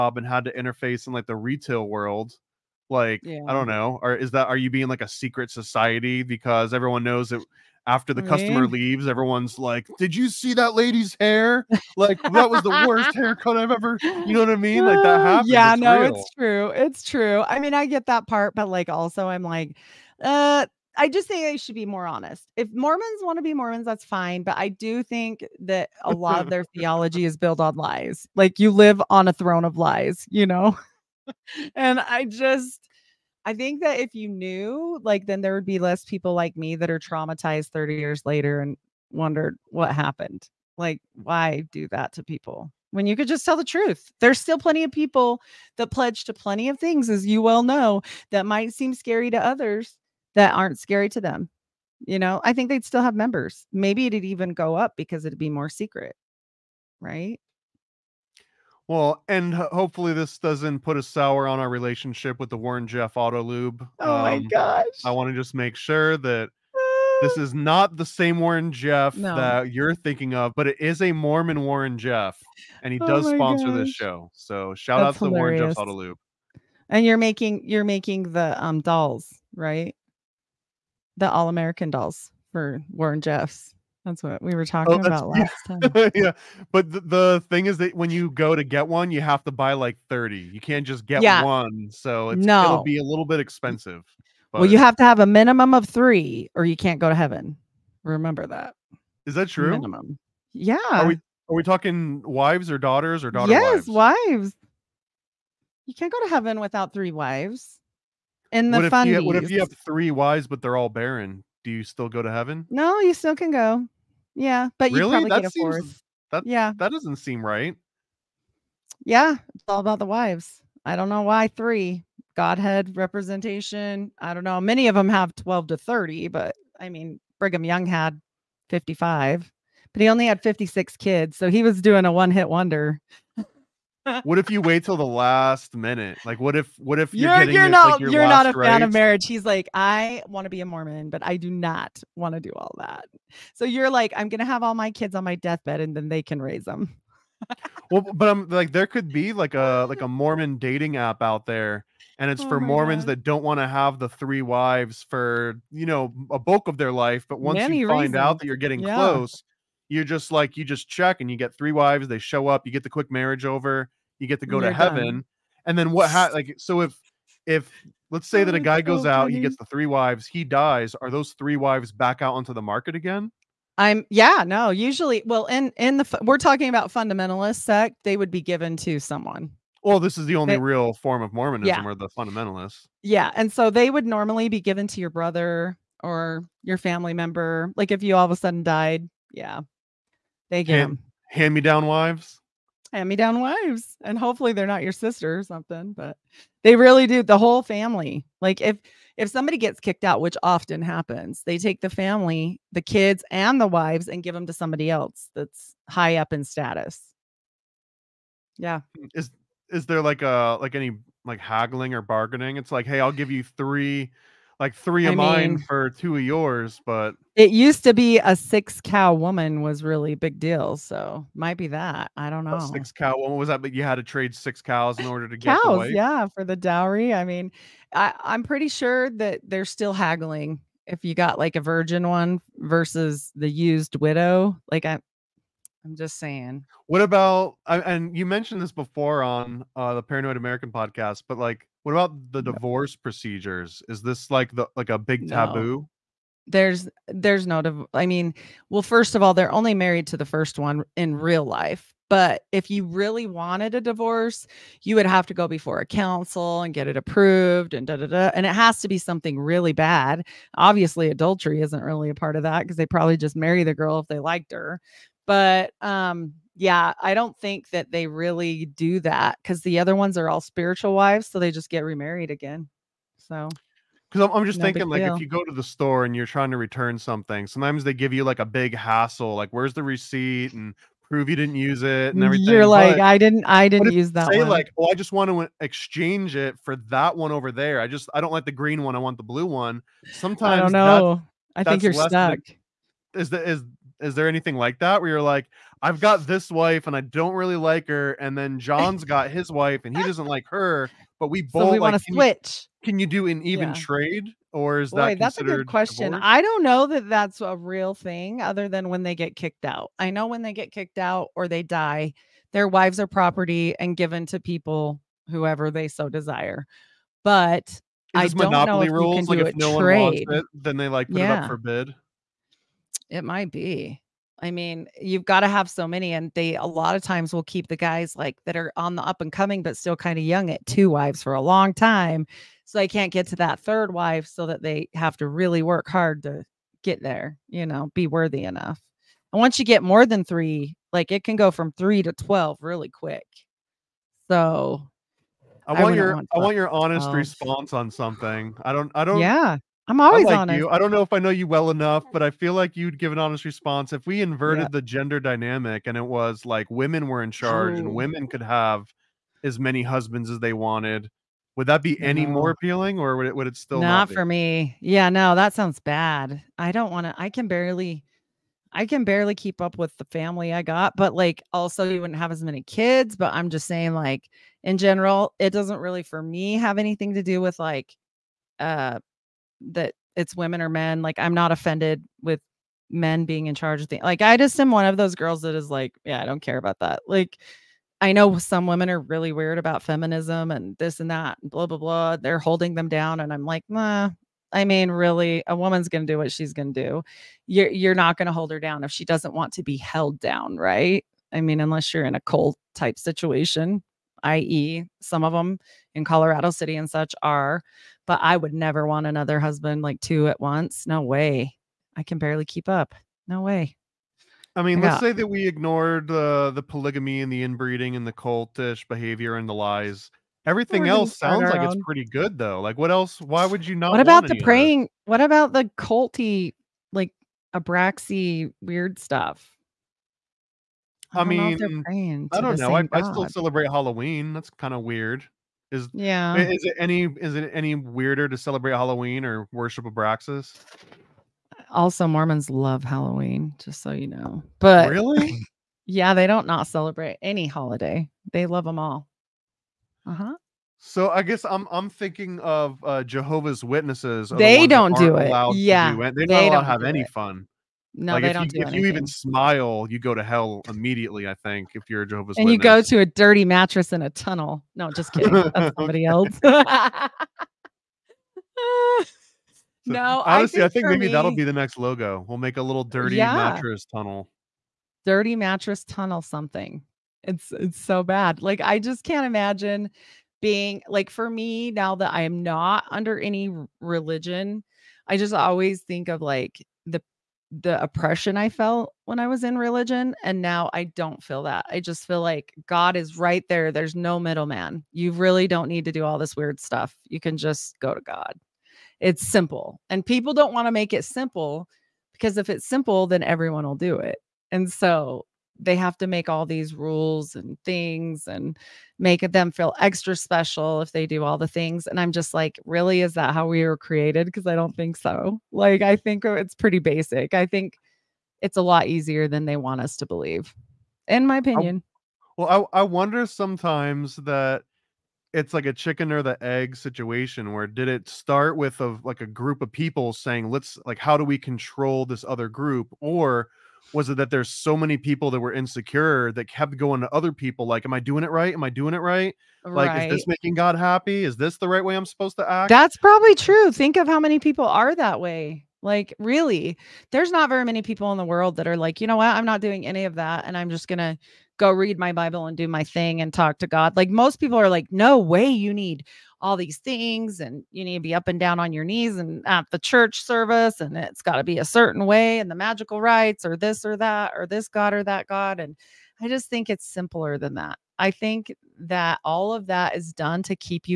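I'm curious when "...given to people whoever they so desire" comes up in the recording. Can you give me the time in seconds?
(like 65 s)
313 s.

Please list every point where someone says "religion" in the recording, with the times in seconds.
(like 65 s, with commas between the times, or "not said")
483 s, 489 s.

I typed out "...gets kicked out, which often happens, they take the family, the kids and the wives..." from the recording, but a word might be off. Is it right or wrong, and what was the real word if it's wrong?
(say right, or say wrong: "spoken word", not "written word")
right.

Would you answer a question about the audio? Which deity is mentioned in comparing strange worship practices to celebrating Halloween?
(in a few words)
Abraxas.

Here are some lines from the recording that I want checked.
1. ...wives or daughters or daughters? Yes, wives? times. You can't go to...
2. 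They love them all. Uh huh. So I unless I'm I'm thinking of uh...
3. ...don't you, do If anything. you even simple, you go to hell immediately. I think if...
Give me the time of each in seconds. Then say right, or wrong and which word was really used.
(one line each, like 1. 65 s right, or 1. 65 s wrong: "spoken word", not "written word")
1. 102 s wrong: "wives", not "times"
2. 448 s wrong: "guess", not "unless"
3. 458 s wrong: "smile", not "simple".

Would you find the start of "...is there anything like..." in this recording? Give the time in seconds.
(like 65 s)
293 s.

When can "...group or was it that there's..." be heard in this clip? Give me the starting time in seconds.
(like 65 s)
532 s.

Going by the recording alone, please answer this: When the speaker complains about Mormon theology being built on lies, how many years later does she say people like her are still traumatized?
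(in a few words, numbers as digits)
30.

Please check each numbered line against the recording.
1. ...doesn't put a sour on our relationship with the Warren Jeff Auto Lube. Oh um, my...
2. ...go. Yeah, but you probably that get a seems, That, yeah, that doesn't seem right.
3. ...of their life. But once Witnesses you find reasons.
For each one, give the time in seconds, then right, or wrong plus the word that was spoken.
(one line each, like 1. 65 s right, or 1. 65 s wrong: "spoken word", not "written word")
1. 60 s right
2. 113 s right
3. 156 s wrong: "Many", not "Witnesses".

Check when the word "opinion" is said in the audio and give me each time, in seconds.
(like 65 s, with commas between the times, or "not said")
521 s.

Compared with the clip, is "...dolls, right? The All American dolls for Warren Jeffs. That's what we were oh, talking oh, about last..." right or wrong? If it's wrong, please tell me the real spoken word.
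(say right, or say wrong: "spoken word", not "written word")
right.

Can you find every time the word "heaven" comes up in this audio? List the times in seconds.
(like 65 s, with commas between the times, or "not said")
97 s, 106 s, 112 s, 164 s.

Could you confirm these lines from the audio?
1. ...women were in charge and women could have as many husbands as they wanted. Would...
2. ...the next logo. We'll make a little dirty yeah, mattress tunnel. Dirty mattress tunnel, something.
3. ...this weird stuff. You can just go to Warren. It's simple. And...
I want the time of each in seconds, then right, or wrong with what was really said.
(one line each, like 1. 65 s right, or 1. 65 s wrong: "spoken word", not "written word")
1. 356 s right
2. 471 s right
3. 496 s wrong: "God", not "Warren".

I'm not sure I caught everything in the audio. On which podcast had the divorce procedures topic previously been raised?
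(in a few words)
Paranoid American.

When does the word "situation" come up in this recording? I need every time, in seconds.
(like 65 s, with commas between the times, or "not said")
402 s, 526 s.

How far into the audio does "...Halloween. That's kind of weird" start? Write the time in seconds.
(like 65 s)
433 s.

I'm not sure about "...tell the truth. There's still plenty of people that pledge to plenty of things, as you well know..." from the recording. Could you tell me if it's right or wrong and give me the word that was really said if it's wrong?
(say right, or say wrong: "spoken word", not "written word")
right.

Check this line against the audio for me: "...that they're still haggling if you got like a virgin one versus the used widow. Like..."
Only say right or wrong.
right.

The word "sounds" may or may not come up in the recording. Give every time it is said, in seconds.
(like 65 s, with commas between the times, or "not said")
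365 s, 421 s.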